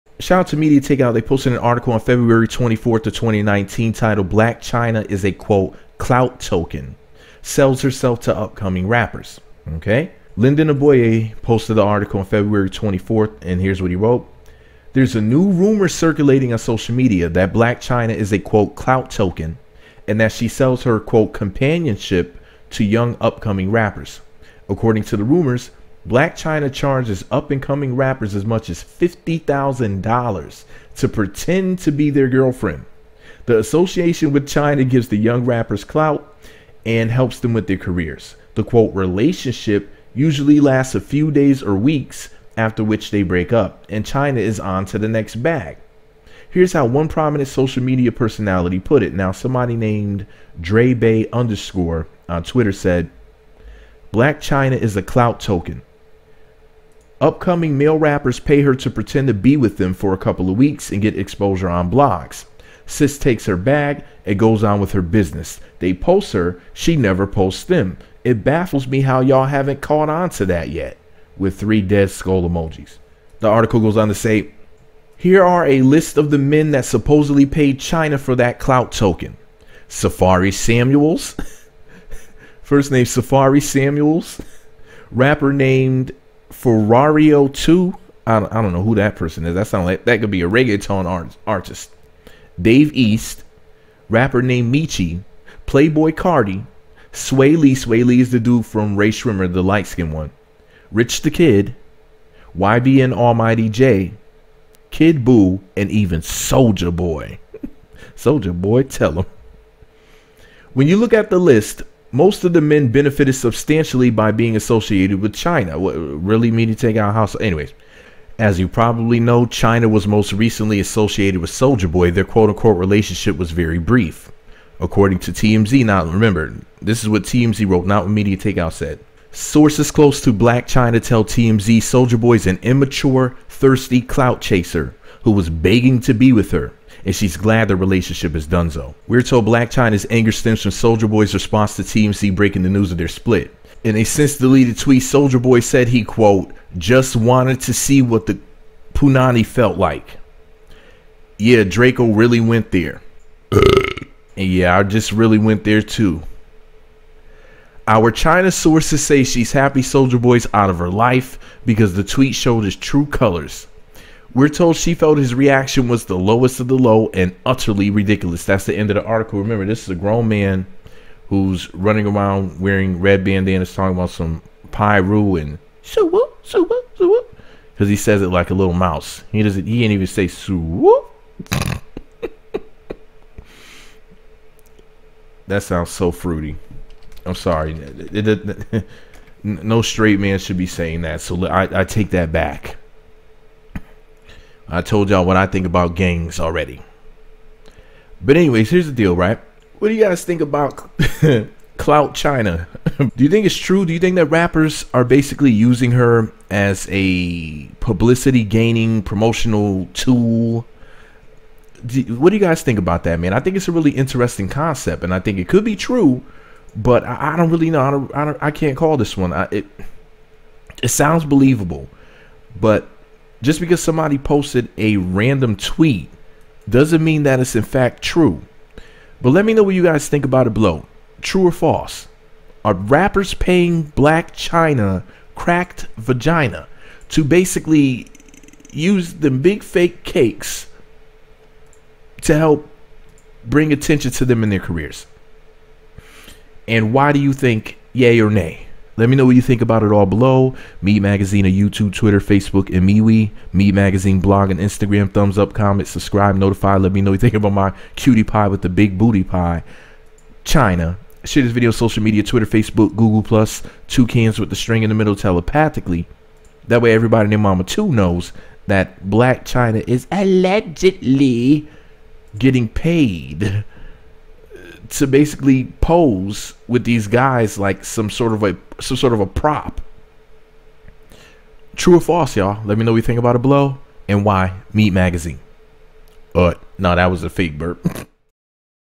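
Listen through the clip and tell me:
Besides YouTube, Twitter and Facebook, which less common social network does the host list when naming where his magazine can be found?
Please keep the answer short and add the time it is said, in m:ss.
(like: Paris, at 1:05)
MeWe, at 4:12.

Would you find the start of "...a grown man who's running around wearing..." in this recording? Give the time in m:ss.
2:49.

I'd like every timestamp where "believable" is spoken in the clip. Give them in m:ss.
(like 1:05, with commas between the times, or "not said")
3:41.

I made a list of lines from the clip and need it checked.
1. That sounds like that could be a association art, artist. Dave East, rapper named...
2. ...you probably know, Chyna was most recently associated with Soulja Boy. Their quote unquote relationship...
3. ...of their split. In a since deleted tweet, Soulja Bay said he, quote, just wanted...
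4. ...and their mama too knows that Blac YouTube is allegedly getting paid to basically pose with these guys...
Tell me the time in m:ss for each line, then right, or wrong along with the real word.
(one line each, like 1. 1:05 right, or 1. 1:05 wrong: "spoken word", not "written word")
1. 1:29 wrong: "reggaeton", not "association"
2. 1:58 right
3. 2:22 wrong: "Boy", not "Bay"
4. 4:27 wrong: "Chyna", not "YouTube".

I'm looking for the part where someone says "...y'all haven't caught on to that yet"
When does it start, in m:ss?
1:09.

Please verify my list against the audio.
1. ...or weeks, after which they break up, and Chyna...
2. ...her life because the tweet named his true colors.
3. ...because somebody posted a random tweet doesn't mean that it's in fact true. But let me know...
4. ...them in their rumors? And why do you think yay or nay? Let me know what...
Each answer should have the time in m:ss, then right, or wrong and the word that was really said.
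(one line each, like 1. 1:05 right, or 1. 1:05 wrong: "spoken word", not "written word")
1. 0:41 right
2. 2:40 wrong: "showed", not "named"
3. 3:43 right
4. 4:04 wrong: "careers", not "rumors".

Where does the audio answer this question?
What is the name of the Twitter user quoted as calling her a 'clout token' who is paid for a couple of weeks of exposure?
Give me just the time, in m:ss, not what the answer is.
0:50.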